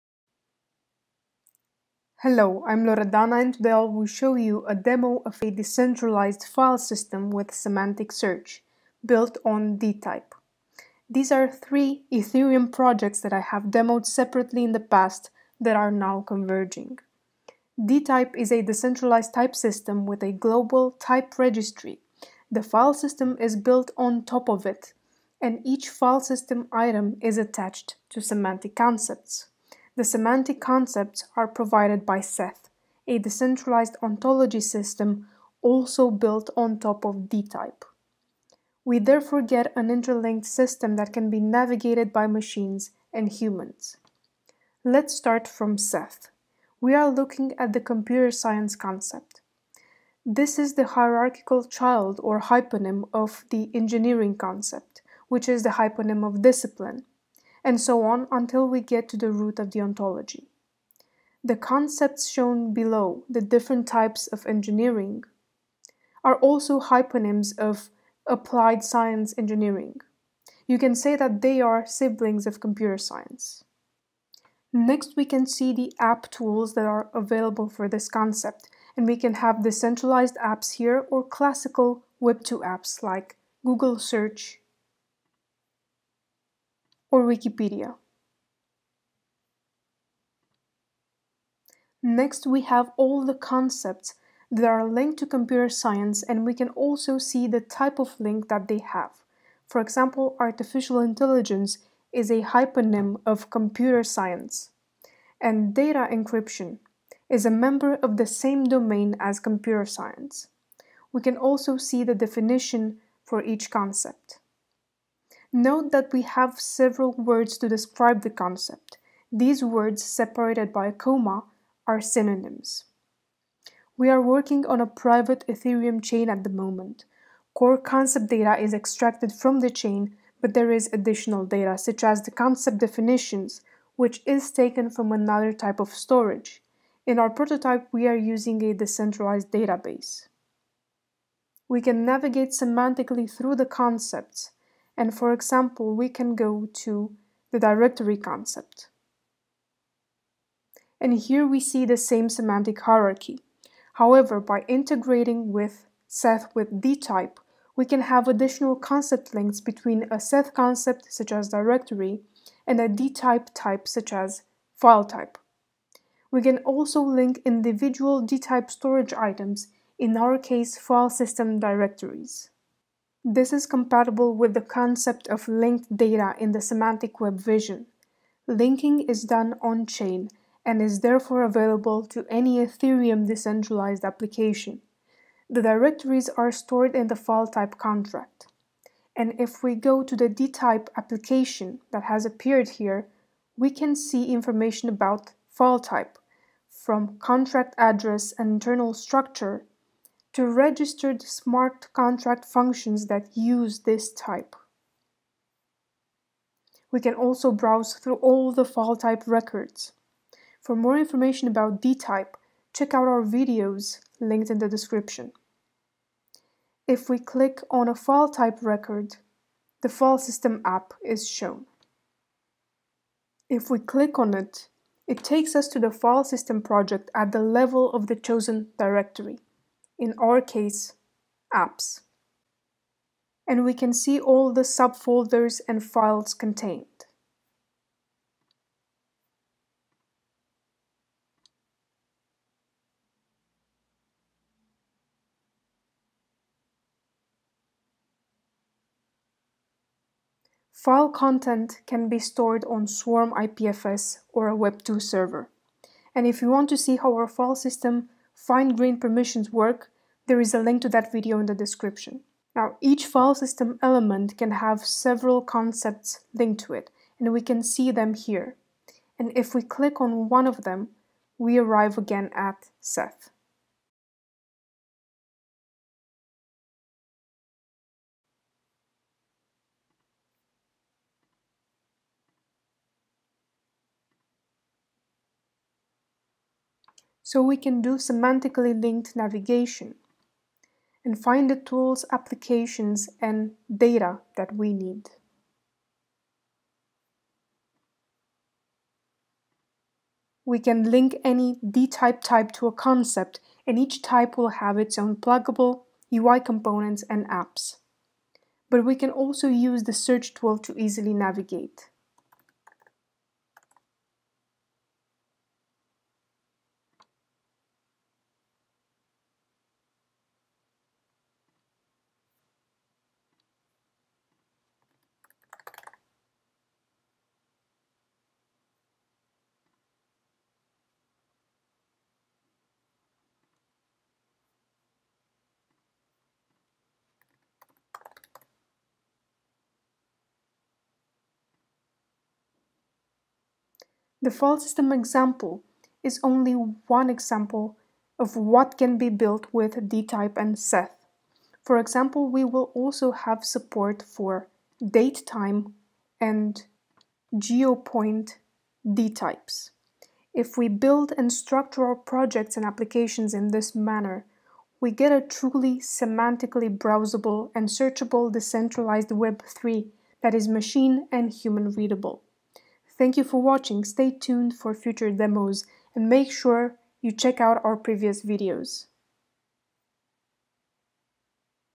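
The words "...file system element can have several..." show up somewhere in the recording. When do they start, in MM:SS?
04:23.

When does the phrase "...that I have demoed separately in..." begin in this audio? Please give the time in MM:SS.
00:13.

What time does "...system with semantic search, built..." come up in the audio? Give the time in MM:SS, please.
00:06.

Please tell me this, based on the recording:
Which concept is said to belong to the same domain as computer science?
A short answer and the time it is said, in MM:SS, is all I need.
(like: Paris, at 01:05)
Data encryption, at 01:45.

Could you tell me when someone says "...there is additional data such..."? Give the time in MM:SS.
02:10.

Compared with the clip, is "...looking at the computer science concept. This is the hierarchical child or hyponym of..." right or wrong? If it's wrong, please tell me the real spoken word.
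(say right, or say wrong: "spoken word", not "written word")
right.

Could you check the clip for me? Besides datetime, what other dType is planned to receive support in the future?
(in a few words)
Geopoint.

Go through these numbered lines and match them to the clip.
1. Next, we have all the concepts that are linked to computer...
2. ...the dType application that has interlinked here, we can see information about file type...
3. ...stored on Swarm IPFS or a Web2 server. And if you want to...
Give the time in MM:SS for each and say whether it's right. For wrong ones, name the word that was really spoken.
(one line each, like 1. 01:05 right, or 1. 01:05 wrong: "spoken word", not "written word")
1. 01:32 right
2. 03:10 wrong: "appeared", not "interlinked"
3. 04:12 right.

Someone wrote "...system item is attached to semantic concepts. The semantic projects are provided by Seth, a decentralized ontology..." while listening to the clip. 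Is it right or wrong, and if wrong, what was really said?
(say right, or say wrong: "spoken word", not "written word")
wrong: "concepts", not "projects".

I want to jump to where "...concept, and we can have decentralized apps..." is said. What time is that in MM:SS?
01:18.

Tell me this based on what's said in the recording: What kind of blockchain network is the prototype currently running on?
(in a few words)
A private Ethereum chain.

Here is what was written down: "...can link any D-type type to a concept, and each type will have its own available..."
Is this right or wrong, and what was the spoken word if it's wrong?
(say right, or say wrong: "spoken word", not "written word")
wrong: "pluggable", not "available".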